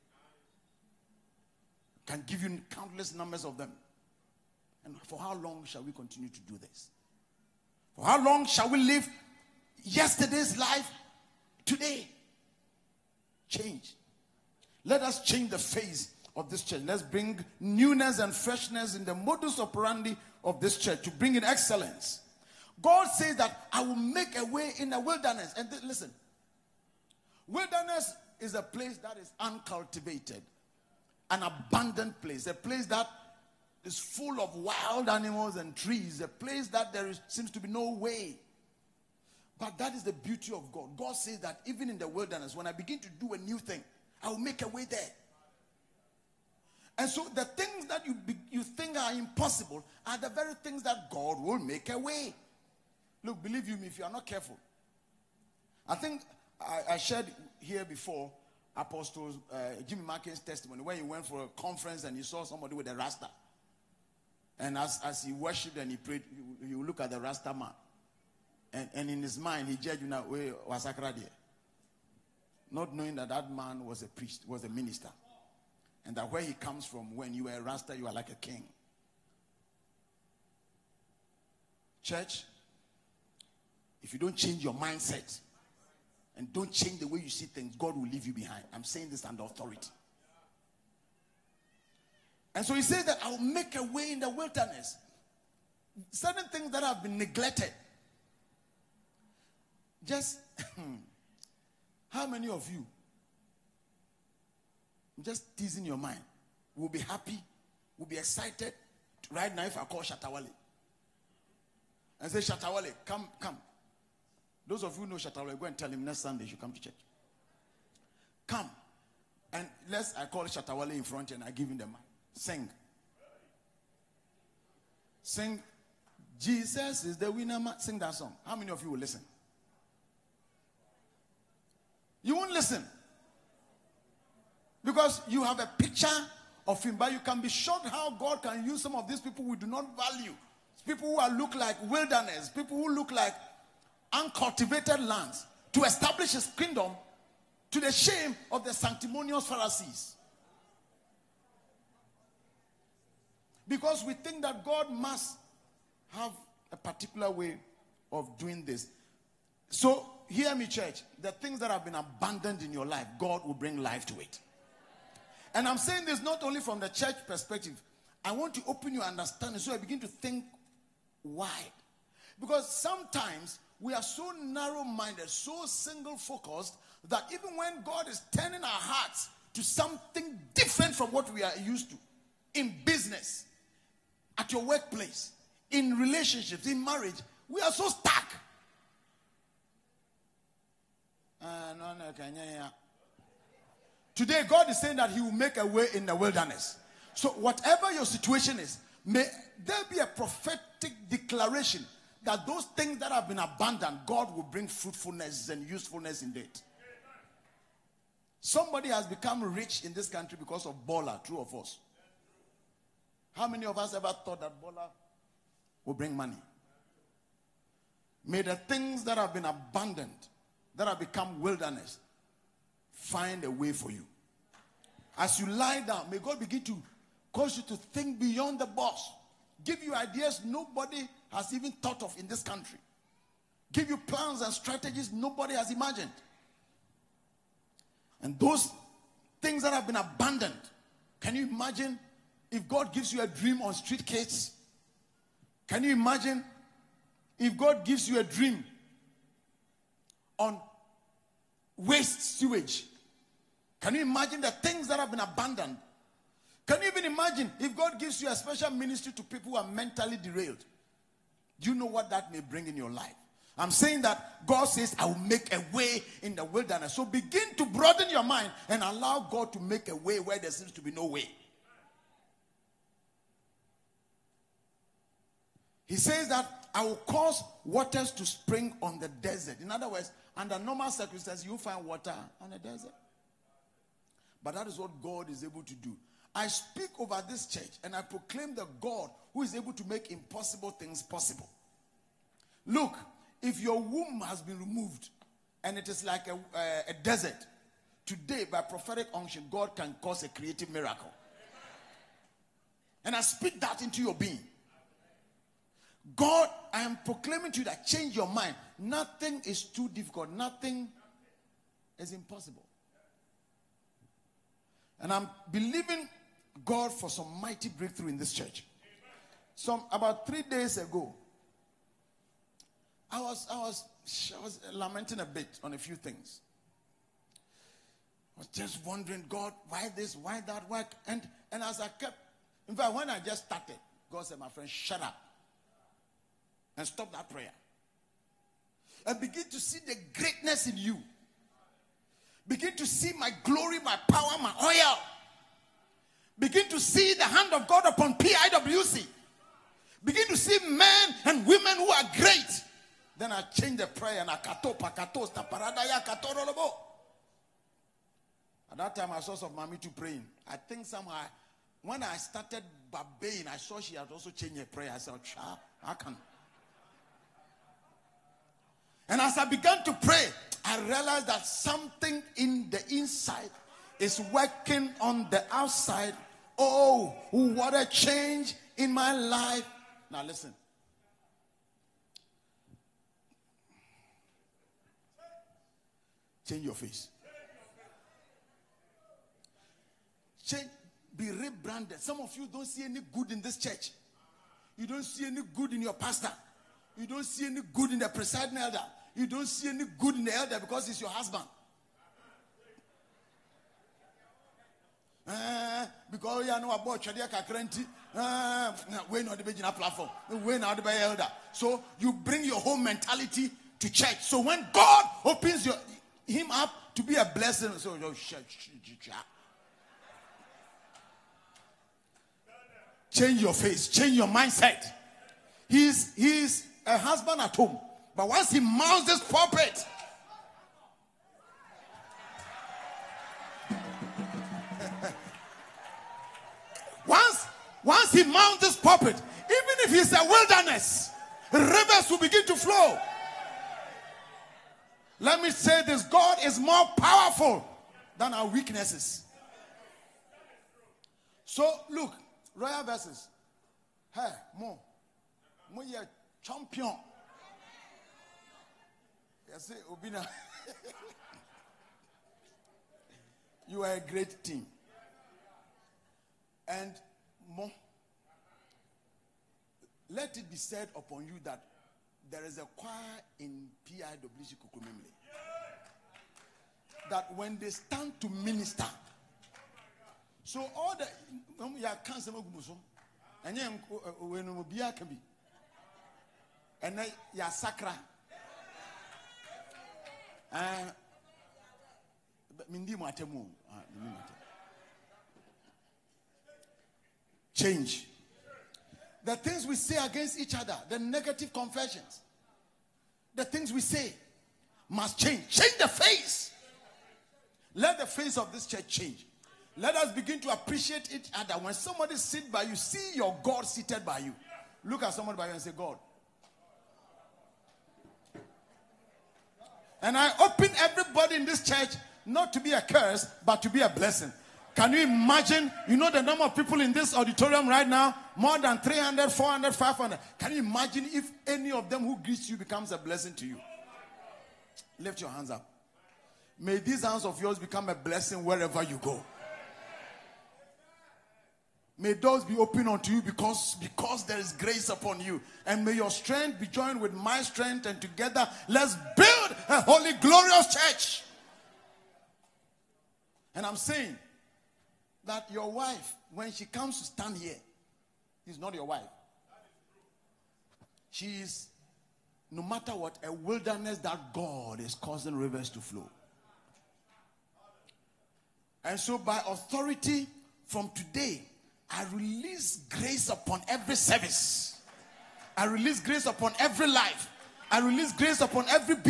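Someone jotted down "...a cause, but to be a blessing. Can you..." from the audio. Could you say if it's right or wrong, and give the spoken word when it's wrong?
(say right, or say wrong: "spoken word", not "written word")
wrong: "curse", not "cause".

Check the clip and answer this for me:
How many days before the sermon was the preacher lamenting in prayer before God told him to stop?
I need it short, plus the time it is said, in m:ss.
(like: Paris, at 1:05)
3, at 5:20.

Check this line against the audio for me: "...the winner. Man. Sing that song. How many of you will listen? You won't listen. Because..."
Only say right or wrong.
right.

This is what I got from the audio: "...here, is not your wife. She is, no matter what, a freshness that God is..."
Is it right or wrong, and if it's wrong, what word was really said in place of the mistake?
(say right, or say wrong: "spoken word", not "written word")
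wrong: "wilderness", not "freshness".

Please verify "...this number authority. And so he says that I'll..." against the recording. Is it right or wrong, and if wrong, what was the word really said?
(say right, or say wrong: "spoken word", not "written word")
wrong: "under", not "number".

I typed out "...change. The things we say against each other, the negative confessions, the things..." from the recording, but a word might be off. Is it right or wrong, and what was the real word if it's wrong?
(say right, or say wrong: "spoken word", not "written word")
right.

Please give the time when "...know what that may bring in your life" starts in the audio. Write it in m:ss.
4:21.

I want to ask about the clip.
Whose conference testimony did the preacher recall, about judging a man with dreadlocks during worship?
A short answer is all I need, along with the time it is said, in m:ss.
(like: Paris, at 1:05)
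Jimmy Markin, at 0:59.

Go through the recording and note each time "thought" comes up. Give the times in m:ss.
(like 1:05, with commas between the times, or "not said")
3:34, 3:51.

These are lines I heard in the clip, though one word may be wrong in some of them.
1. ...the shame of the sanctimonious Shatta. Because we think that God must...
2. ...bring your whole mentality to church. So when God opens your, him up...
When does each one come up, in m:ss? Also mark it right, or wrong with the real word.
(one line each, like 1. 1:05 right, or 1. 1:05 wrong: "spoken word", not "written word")
1. 2:27 wrong: "Pharisees", not "Shatta"
2. 6:52 right.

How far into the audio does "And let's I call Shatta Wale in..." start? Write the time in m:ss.
1:59.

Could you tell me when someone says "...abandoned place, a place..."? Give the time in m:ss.
0:31.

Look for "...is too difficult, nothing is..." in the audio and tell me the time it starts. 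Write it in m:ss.
5:09.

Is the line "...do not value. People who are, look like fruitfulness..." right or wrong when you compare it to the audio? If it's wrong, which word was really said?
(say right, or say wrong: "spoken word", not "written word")
wrong: "wilderness", not "fruitfulness".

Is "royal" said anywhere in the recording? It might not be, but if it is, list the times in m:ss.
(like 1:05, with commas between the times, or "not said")
7:32.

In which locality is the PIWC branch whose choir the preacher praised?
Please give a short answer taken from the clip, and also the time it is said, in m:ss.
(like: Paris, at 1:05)
Kokomlemle, at 7:54.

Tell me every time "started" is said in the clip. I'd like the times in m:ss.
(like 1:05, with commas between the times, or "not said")
5:33, 6:02.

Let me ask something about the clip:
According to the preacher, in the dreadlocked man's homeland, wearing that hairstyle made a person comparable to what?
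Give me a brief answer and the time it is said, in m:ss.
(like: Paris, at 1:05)
a king, at 1:18.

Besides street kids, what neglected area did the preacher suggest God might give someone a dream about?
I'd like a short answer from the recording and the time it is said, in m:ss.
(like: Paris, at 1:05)
waste sewage, at 4:11.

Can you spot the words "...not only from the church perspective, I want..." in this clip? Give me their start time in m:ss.
2:46.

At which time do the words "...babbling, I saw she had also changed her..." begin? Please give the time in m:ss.
6:02.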